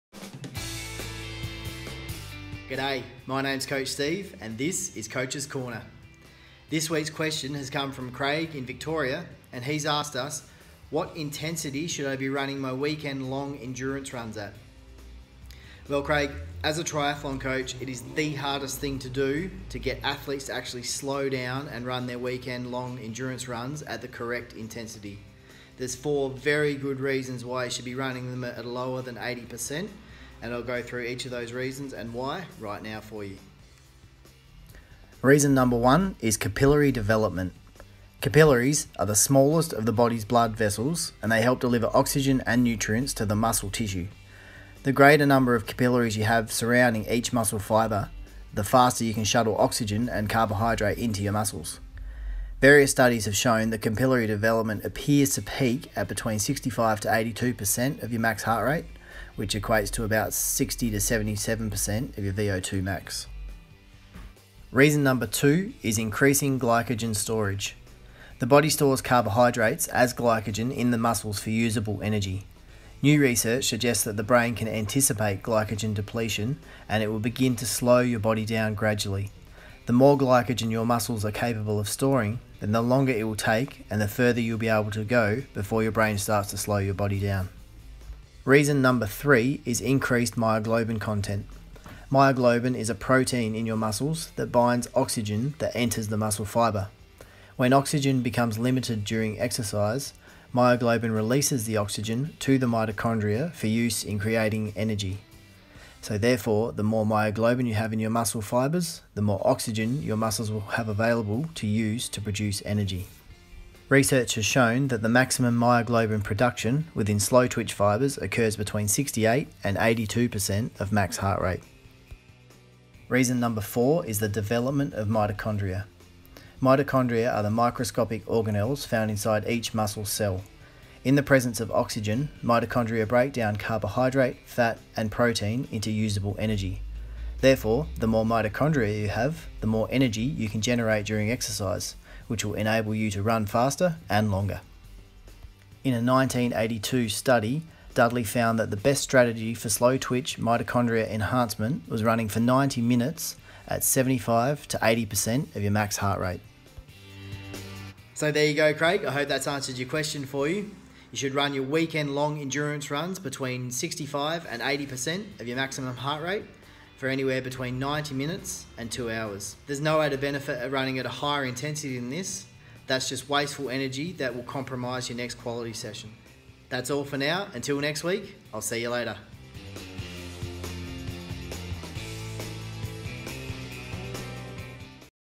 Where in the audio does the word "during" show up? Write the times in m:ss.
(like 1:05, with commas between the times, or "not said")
1:39, 2:21.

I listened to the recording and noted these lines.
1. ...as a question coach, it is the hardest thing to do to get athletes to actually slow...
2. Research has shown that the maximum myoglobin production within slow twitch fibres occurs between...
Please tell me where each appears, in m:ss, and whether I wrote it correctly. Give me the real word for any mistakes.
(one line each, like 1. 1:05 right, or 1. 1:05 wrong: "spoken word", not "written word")
1. 0:16 wrong: "triathlon", not "question"
2. 1:53 right.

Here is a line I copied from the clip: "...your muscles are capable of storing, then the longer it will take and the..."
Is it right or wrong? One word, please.
right.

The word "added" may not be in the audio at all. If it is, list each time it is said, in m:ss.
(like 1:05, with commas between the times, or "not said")
2:50.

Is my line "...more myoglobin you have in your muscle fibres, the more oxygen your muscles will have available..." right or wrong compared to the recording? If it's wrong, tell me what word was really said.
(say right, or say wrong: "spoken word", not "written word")
right.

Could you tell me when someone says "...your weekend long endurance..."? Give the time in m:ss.
2:41.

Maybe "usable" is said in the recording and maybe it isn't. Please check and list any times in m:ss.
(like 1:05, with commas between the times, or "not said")
1:11, 2:15.